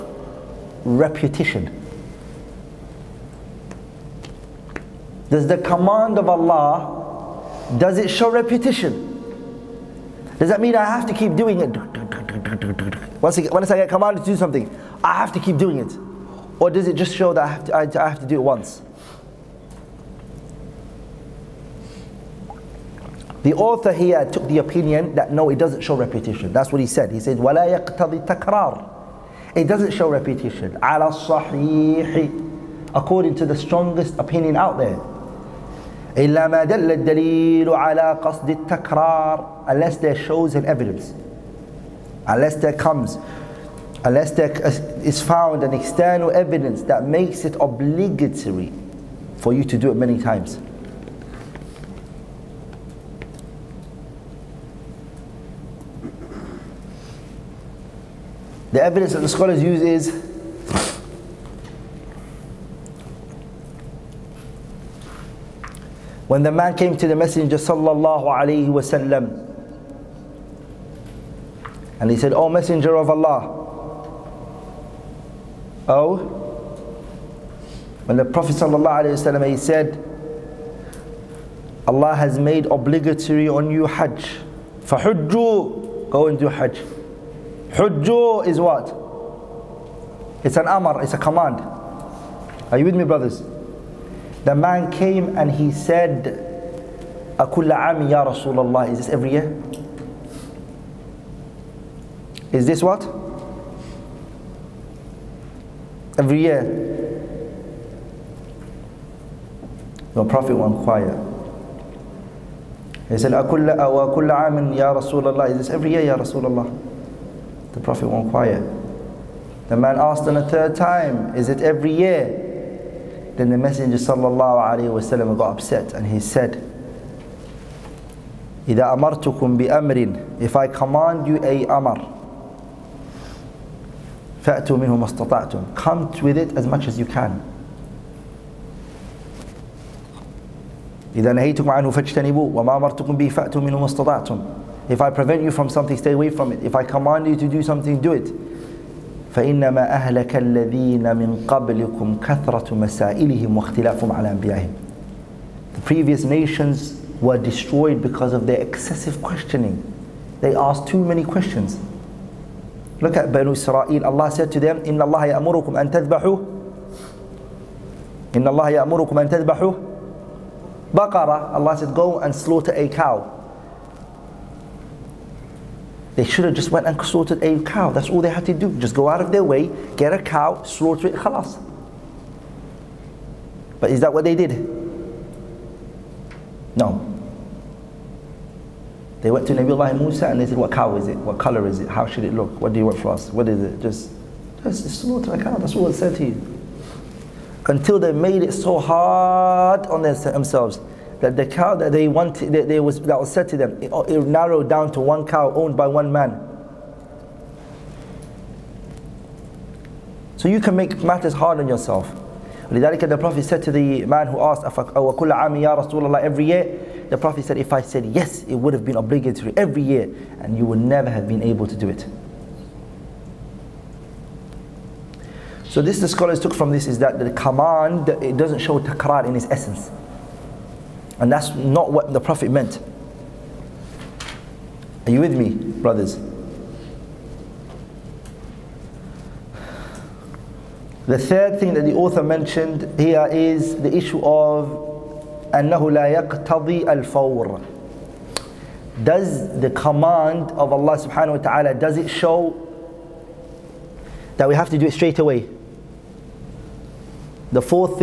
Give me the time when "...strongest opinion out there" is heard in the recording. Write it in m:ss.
0:33.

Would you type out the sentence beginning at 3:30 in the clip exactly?
So you can make matters hard on yourself.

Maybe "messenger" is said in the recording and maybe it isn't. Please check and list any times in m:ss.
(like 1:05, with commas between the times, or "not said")
1:07, 1:12, 2:03.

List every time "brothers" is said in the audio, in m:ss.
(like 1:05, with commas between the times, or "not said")
1:33, 3:55.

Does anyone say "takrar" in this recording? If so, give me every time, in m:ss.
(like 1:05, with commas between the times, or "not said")
0:28, 3:48.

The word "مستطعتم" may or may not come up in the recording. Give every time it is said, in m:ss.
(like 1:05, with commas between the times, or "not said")
2:15, 2:23.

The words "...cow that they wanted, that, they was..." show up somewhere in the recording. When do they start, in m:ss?
3:21.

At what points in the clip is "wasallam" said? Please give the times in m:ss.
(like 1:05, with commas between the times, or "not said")
1:08, 1:19.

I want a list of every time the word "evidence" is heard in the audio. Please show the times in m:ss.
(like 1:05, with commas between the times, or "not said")
0:40, 0:46, 0:58.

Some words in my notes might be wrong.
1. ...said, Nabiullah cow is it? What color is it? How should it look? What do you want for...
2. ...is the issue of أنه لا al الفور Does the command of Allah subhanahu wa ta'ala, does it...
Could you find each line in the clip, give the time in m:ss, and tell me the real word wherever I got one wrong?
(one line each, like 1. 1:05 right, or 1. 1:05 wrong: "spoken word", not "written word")
1. 3:10 wrong: "What", not "Nabiullah"
2. 4:03 right.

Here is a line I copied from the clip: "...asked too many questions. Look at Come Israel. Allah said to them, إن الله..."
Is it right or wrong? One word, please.
wrong.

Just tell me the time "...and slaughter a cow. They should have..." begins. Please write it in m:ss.
2:52.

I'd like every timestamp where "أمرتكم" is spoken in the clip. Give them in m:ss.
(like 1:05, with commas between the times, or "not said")
2:08, 2:22.